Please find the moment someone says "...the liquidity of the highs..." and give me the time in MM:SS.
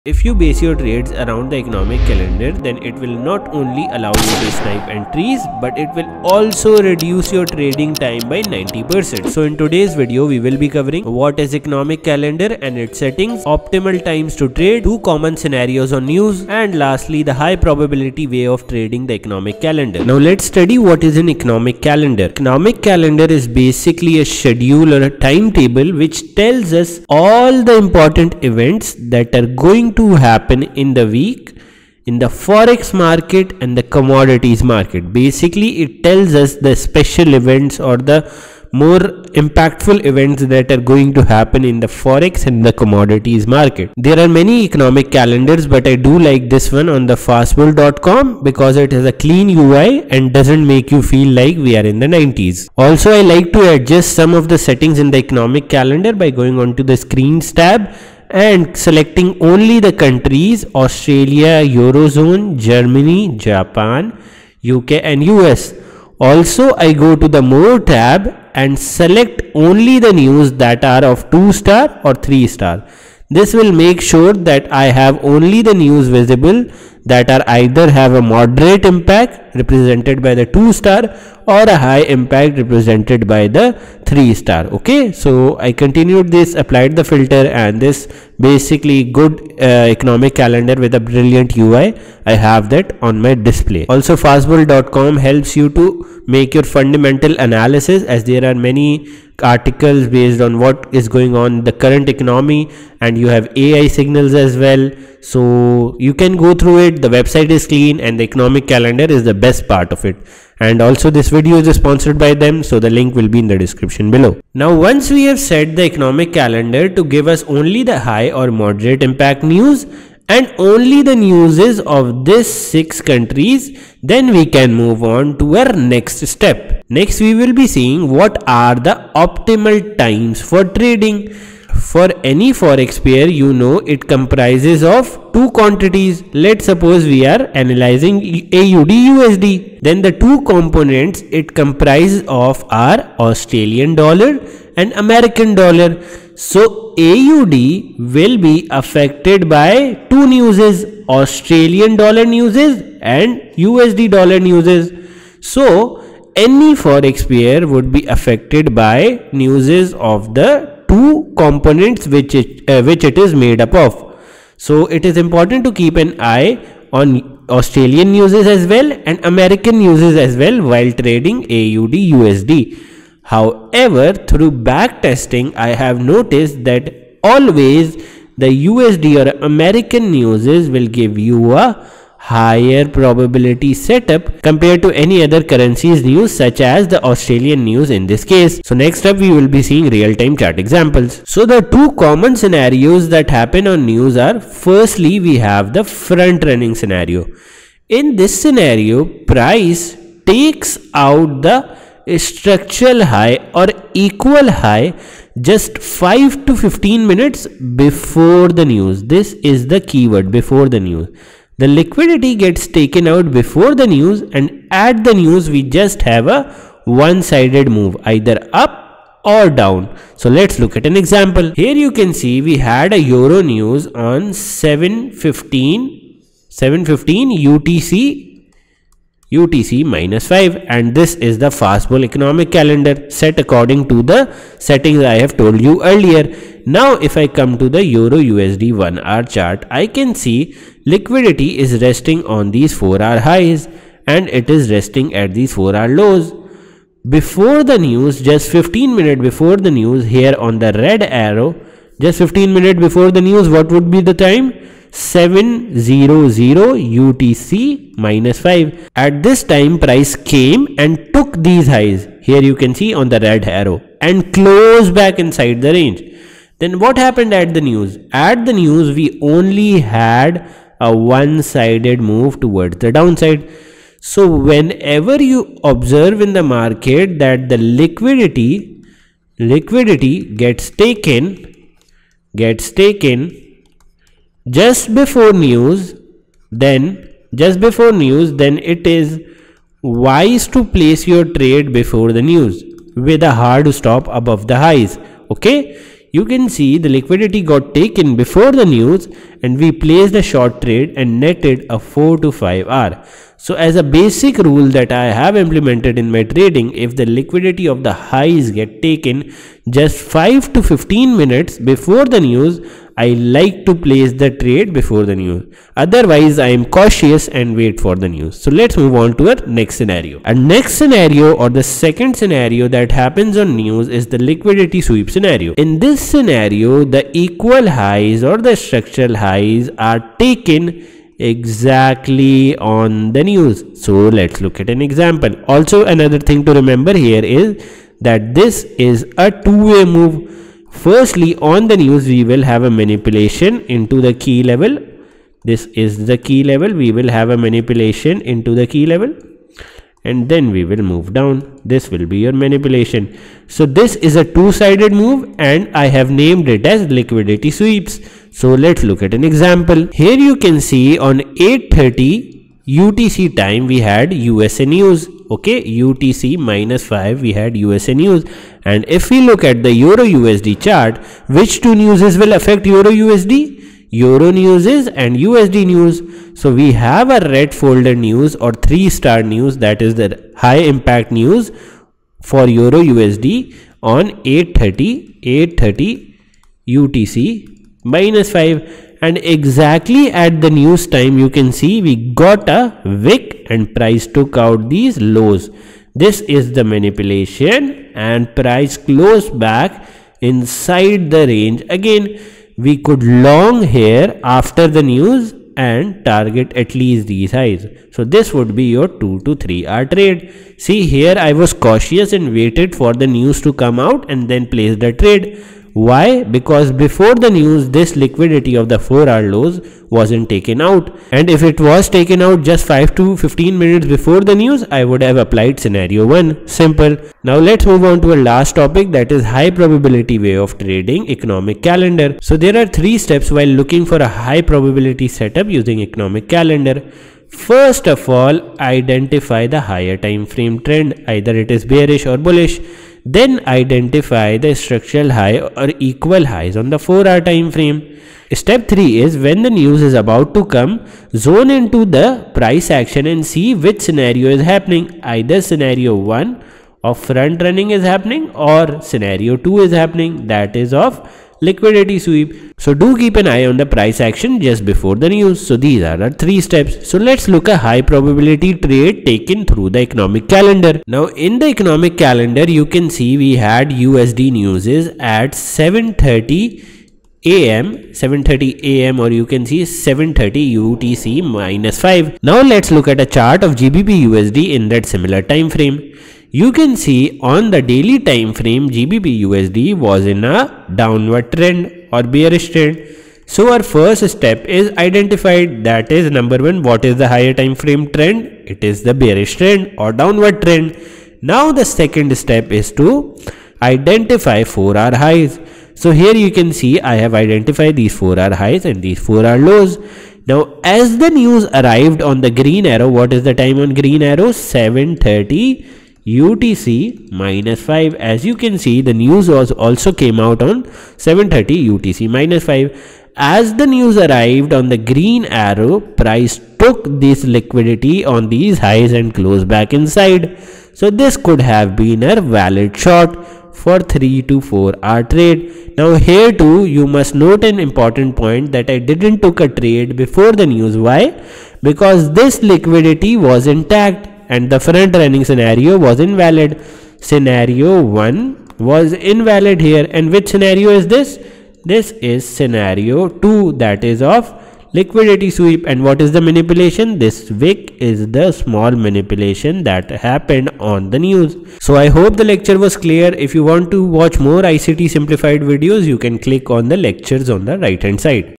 05:06.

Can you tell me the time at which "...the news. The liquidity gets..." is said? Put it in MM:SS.
03:30.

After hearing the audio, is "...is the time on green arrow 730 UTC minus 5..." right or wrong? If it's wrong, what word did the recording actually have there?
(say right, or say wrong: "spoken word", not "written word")
right.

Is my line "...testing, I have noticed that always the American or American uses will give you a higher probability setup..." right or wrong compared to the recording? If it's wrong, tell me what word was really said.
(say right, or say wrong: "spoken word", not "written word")
wrong: "USD", not "American".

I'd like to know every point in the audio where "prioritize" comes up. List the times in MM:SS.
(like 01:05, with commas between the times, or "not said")
not said.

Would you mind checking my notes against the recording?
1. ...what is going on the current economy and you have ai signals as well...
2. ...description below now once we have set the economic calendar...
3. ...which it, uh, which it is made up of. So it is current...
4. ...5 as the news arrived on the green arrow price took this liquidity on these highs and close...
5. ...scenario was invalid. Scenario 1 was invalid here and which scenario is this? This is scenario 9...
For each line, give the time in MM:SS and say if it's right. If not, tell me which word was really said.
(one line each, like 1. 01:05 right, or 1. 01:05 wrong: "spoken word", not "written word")
1. 01:40 right
2. 01:53 right
3. 02:42 wrong: "important", not "current"
4. 08:42 right
5. 09:05 wrong: "2", not "9".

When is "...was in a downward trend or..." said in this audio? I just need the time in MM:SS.
08:09.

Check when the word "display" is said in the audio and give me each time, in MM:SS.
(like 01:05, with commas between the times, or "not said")
01:33.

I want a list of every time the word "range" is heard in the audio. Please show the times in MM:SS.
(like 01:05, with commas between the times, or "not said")
04:25, 06:41.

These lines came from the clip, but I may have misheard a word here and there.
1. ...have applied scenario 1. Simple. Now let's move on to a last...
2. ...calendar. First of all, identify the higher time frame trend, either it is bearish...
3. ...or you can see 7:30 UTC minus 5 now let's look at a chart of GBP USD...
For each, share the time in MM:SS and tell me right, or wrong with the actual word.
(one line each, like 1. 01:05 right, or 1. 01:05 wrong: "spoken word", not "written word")
1. 07:05 right
2. 07:16 right
3. 07:58 right.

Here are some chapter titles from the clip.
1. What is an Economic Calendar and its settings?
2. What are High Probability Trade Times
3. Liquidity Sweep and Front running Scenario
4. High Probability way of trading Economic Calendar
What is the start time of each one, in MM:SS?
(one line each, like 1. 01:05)
1. 00:20
2. 02:15
3. 03:15
4. 07:00.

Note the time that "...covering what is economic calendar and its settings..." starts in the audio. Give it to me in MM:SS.
00:10.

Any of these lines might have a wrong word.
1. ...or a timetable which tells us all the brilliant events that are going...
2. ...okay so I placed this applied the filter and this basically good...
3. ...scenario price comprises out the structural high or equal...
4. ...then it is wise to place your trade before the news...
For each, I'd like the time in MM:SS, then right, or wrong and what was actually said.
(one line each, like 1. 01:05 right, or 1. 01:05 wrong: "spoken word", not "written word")
1. 00:24 wrong: "important", not "brilliant"
2. 01:24 wrong: "continued", not "placed"
3. 03:18 wrong: "takes", not "comprises"
4. 04:48 right.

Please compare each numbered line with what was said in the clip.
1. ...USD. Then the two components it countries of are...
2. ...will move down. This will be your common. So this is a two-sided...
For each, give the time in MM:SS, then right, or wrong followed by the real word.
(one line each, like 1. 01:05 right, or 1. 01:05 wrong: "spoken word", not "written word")
1. 02:19 wrong: "comprises", not "countries"
2. 05:50 wrong: "manipulation", not "common".